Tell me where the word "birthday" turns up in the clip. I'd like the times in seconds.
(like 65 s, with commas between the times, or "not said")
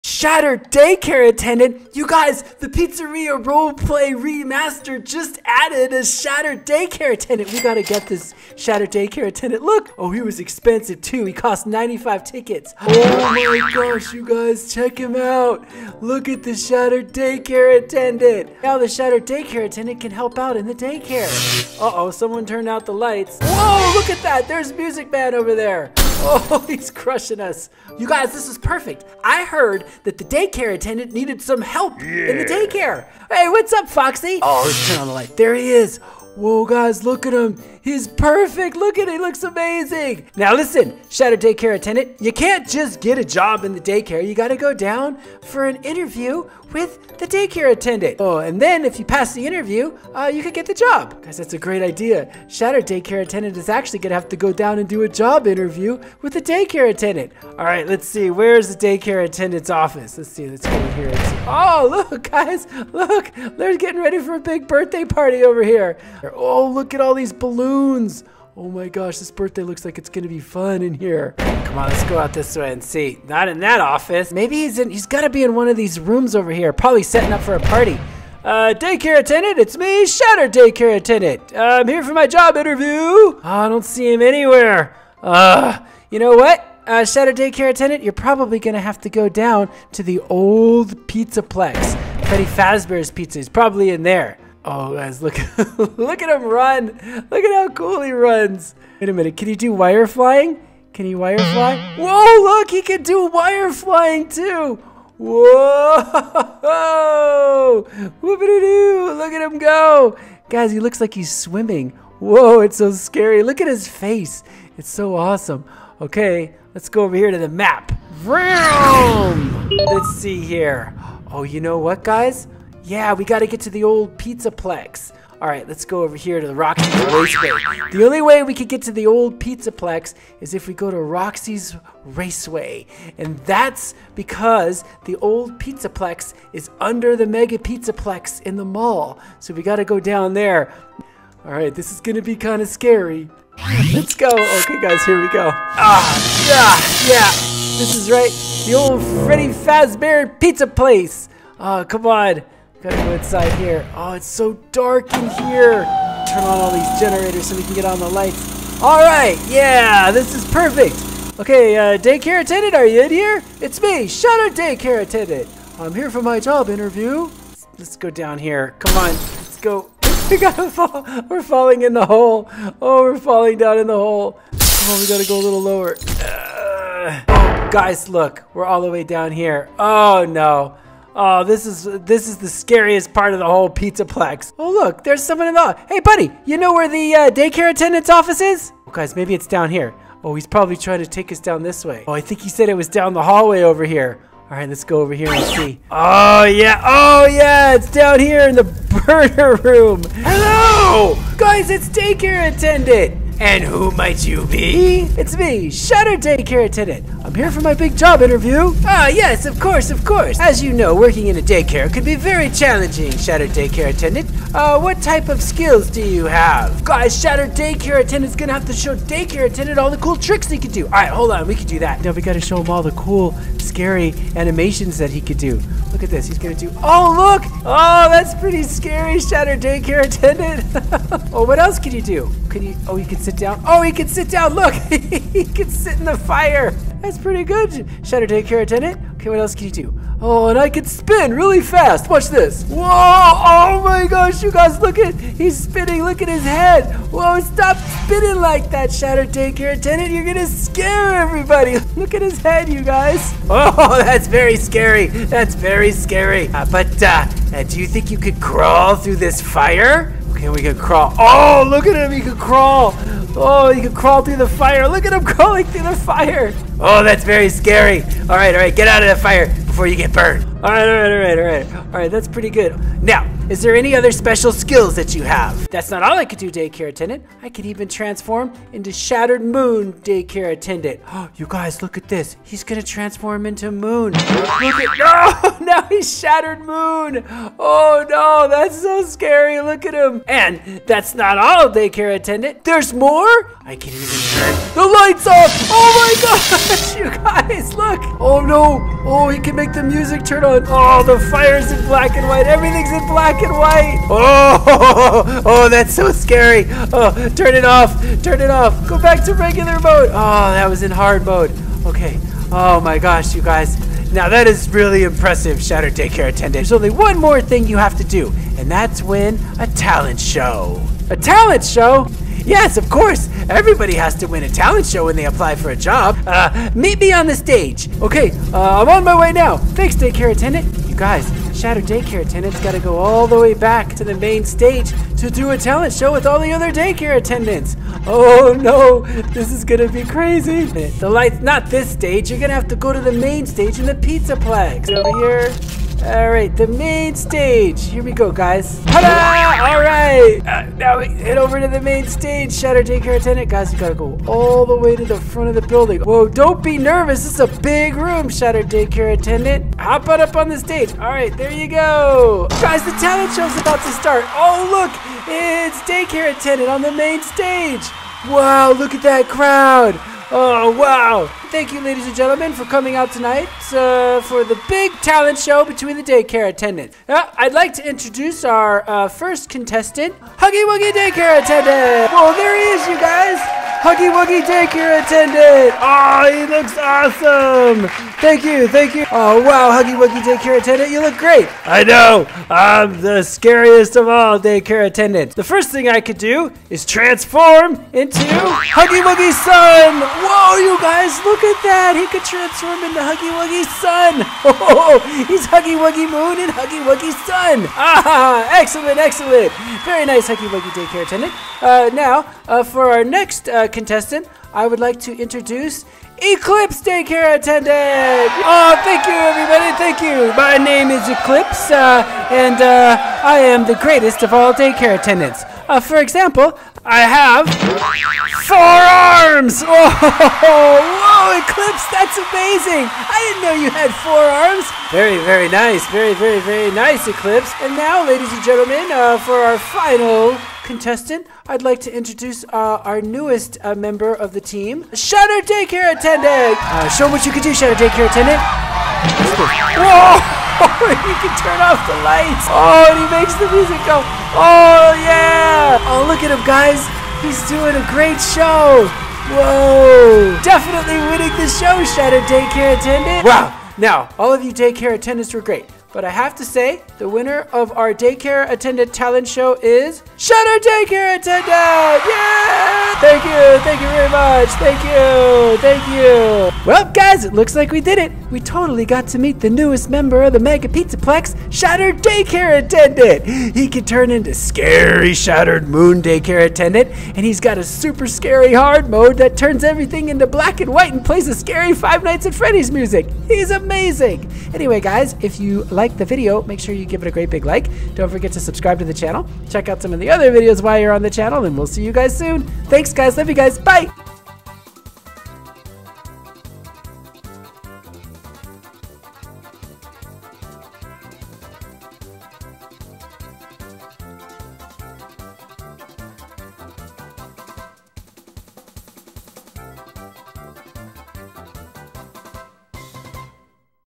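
64 s, 69 s.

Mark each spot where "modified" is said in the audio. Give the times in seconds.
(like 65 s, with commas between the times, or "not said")
not said.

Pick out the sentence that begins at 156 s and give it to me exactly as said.
Turn on all these generators so we can get on the lights.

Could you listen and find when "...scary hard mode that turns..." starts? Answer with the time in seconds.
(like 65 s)
488 s.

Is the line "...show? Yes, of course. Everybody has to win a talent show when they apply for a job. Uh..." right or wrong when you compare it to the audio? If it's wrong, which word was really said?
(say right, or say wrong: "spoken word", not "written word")
right.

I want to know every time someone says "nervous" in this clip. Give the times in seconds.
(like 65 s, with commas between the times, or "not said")
356 s.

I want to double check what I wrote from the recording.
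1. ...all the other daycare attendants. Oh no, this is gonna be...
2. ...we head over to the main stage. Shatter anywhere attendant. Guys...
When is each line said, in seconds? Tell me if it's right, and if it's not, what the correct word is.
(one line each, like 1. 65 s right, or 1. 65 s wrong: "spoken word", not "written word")
1. 336 s right
2. 350 s wrong: "daycare", not "anywhere".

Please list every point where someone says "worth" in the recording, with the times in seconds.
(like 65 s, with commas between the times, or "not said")
not said.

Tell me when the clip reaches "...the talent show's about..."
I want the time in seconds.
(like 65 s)
362 s.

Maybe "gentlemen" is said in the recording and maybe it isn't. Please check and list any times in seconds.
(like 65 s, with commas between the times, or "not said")
372 s, 438 s.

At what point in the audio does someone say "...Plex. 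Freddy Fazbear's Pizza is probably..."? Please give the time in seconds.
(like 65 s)
91 s.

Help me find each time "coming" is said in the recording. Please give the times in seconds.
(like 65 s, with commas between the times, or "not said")
372 s.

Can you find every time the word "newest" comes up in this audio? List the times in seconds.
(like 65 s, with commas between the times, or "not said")
443 s, 479 s.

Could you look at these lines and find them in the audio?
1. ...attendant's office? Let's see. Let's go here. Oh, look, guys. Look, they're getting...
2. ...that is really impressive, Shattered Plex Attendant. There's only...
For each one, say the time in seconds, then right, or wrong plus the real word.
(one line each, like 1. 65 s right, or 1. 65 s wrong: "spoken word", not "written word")
1. 59 s right
2. 314 s wrong: "Daycare", not "Plex".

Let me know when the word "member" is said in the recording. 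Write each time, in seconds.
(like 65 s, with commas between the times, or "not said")
443 s, 479 s.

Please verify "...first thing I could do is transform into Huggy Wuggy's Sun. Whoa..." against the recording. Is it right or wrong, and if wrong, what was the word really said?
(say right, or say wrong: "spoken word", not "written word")
right.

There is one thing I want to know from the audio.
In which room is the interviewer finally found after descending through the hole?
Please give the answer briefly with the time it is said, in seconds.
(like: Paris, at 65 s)
burner room, at 199 s.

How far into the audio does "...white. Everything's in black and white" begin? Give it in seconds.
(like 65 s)
302 s.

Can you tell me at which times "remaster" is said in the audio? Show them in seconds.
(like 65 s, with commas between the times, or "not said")
4 s.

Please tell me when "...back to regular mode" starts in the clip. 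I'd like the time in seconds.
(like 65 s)
308 s.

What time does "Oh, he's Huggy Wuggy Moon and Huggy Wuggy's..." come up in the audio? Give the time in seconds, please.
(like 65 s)
404 s.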